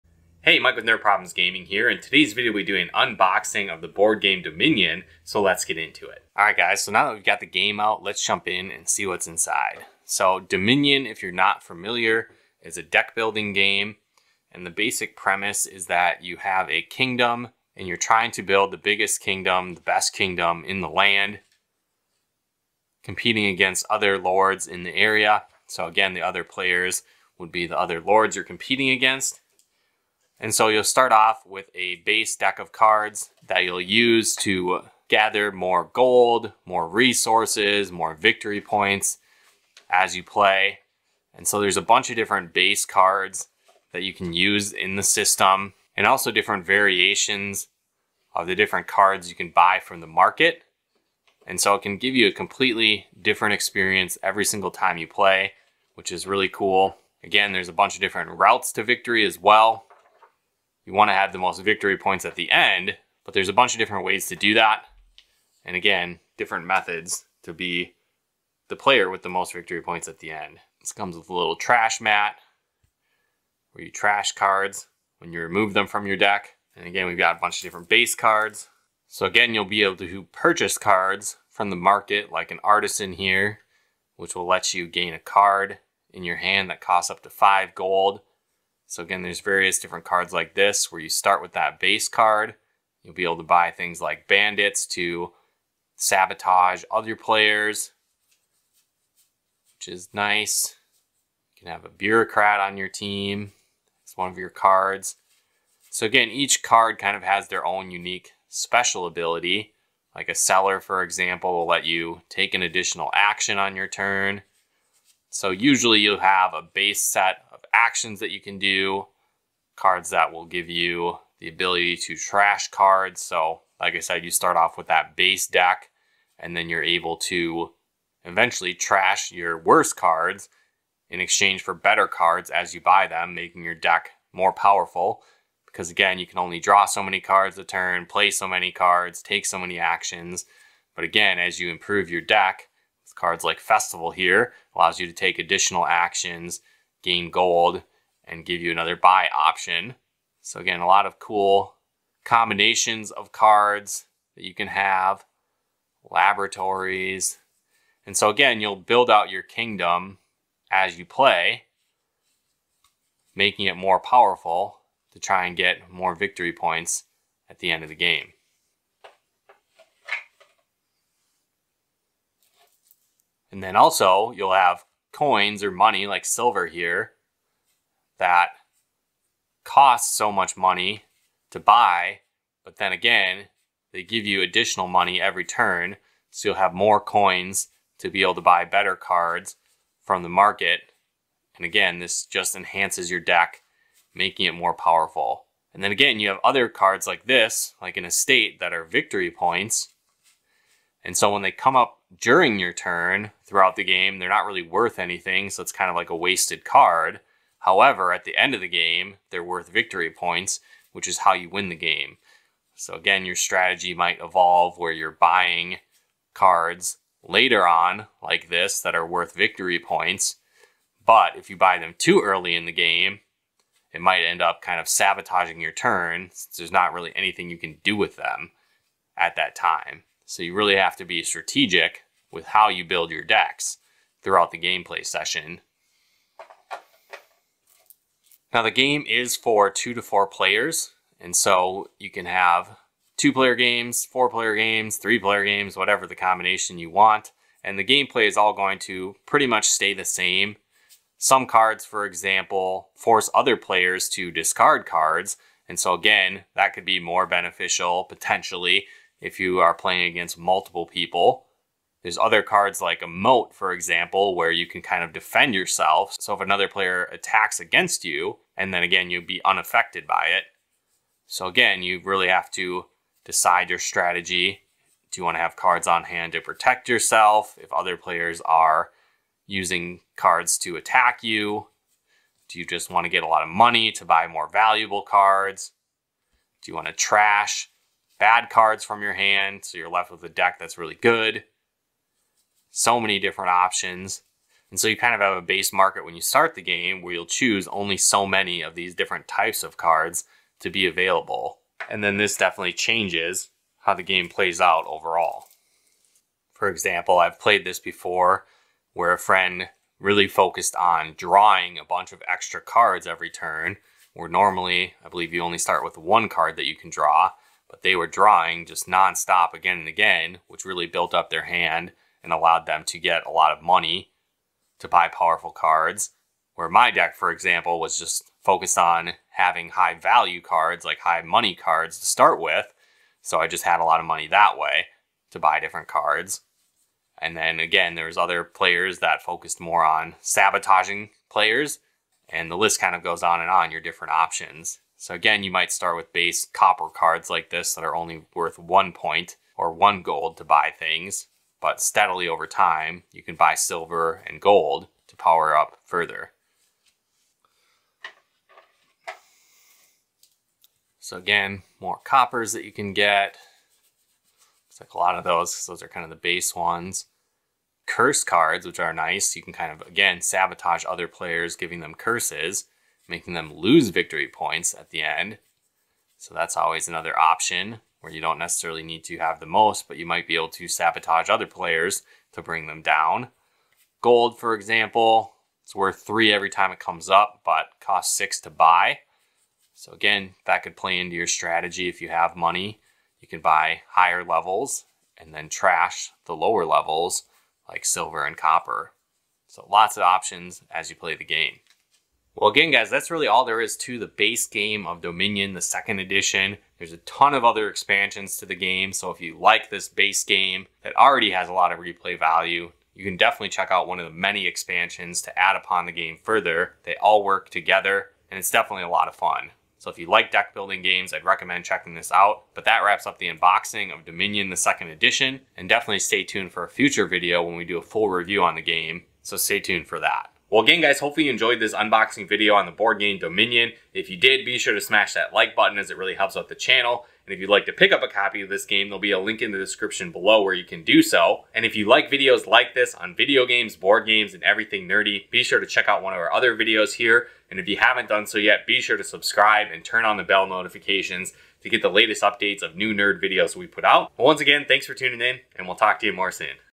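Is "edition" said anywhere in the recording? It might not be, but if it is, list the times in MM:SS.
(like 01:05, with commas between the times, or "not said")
06:45, 07:04.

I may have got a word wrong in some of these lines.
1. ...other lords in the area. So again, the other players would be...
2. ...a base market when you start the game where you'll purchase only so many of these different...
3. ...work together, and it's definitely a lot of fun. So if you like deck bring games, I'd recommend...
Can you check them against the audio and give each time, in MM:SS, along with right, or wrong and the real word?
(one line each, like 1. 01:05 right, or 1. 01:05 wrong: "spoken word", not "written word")
1. 00:23 right
2. 04:55 wrong: "choose", not "purchase"
3. 06:57 wrong: "building", not "bring".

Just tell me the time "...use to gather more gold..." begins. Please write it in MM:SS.
00:33.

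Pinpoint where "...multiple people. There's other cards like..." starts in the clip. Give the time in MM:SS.
04:20.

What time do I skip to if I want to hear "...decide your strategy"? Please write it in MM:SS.
04:33.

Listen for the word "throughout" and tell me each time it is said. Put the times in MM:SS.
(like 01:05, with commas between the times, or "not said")
03:23, 03:54.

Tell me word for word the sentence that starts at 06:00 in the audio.
So again, more coppers that you can get.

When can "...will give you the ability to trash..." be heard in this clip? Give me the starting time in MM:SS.
02:00.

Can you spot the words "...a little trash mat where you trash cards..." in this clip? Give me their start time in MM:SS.
01:11.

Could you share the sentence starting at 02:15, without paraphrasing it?
Because again, you can only draw so many cards a turn, play so many cards, take so many actions.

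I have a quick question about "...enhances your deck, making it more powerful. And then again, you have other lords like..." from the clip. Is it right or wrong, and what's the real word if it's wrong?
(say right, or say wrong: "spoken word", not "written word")
wrong: "cards", not "lords".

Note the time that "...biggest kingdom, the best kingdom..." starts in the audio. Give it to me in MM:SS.
00:18.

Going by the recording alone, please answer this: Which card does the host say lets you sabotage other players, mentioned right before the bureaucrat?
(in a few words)
Bandits.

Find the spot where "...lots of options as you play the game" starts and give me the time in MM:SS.
06:39.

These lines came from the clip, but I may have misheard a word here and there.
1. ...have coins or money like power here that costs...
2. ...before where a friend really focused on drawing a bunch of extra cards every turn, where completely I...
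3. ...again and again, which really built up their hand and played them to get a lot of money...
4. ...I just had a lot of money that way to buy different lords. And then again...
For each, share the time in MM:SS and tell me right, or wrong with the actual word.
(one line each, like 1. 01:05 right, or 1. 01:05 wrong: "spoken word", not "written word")
1. 02:54 wrong: "silver", not "power"
2. 05:07 wrong: "normally", not "completely"
3. 05:19 wrong: "allowed", not "played"
4. 05:33 wrong: "cards", not "lords".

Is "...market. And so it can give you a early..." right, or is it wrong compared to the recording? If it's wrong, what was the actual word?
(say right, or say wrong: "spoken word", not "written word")
wrong: "completely", not "early".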